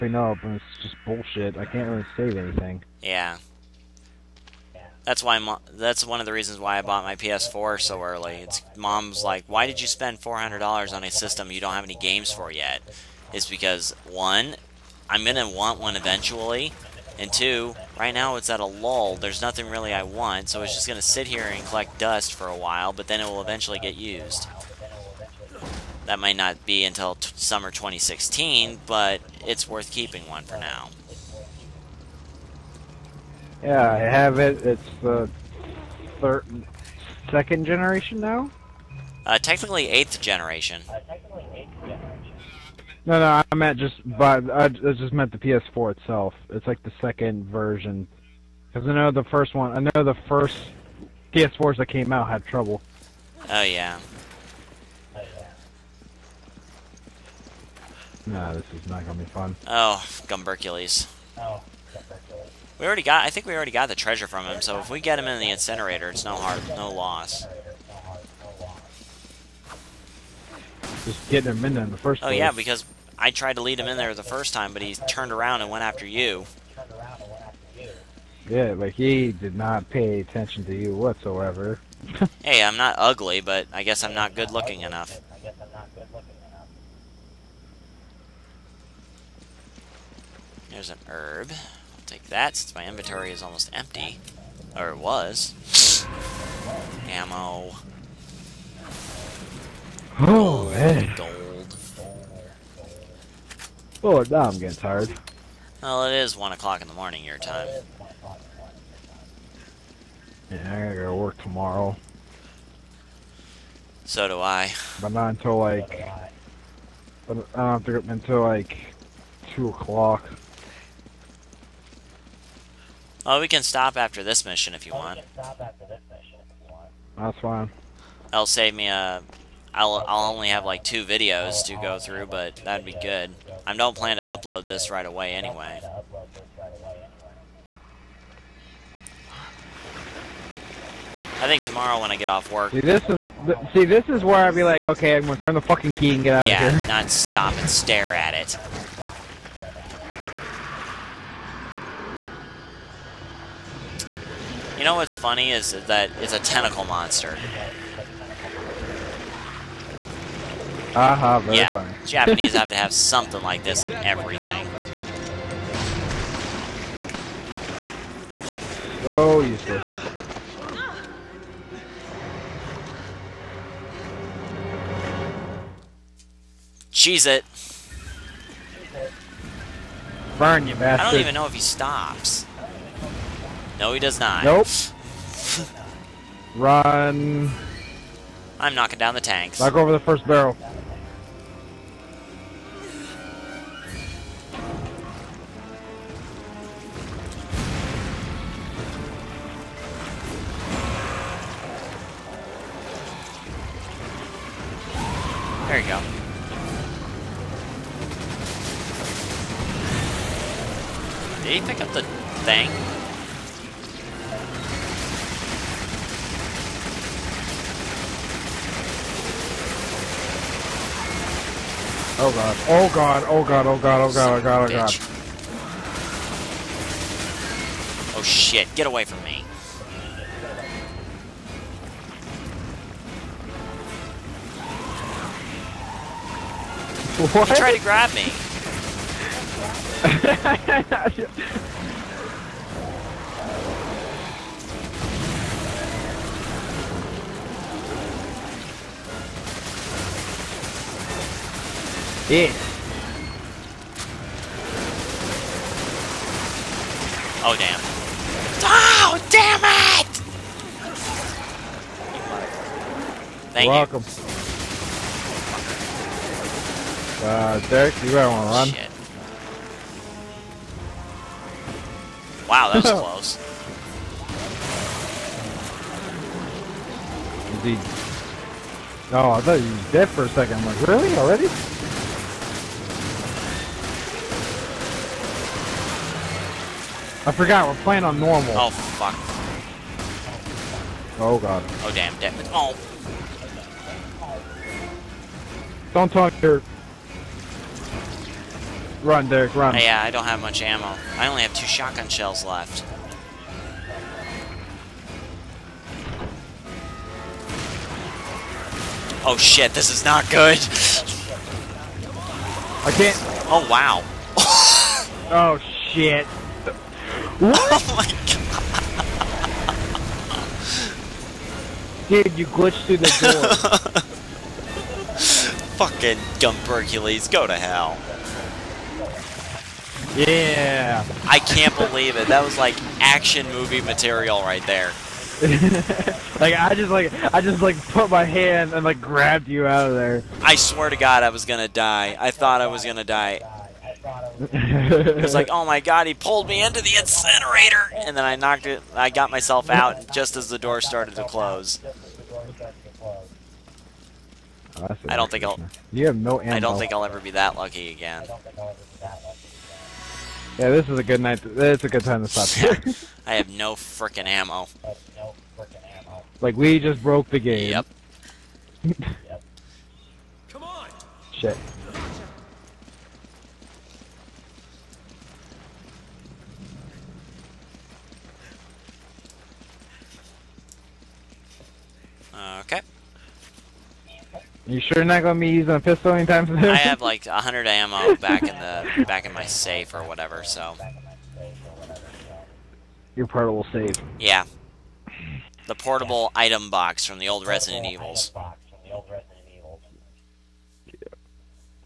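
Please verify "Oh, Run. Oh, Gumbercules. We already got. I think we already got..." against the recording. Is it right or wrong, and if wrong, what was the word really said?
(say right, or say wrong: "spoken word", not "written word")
wrong: "Gumbercules", not "Run".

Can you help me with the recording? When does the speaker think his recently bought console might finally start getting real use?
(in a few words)
summer 2016.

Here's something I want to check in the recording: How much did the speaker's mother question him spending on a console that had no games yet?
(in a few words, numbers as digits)
$400.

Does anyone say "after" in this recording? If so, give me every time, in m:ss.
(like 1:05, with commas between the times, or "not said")
1:15, 2:03.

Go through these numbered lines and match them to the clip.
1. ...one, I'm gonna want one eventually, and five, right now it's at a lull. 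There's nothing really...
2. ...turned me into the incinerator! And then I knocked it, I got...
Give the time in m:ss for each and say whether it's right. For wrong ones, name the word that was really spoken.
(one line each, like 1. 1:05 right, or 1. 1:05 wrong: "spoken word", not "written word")
1. 0:14 wrong: "two", not "five"
2. 5:46 wrong: "pulled", not "turned".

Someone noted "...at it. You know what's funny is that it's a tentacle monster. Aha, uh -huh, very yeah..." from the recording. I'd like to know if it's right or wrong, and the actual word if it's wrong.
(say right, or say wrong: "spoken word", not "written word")
right.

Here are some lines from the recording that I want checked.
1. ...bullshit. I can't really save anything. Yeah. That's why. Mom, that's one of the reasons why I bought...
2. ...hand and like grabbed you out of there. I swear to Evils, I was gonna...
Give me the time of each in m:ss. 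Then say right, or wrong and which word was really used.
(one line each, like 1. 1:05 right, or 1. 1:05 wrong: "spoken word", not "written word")
1. 0:01 right
2. 5:38 wrong: "God", not "Evils".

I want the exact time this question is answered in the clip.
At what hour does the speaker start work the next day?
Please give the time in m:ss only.
1:59.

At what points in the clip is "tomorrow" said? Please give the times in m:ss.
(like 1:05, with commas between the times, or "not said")
1:51, 2:21.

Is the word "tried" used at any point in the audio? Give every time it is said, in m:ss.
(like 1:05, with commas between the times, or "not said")
1:13, 3:57.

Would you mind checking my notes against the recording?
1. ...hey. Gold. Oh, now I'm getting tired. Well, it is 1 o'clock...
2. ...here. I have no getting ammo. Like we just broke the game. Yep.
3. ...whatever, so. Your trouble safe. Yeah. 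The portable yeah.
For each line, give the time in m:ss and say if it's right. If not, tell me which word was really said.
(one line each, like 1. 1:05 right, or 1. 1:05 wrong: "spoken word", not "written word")
1. 1:40 right
2. 6:02 wrong: "freaking", not "getting"
3. 6:30 wrong: "portable", not "trouble".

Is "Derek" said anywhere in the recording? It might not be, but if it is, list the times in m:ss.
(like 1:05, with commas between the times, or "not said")
4:27, 4:59.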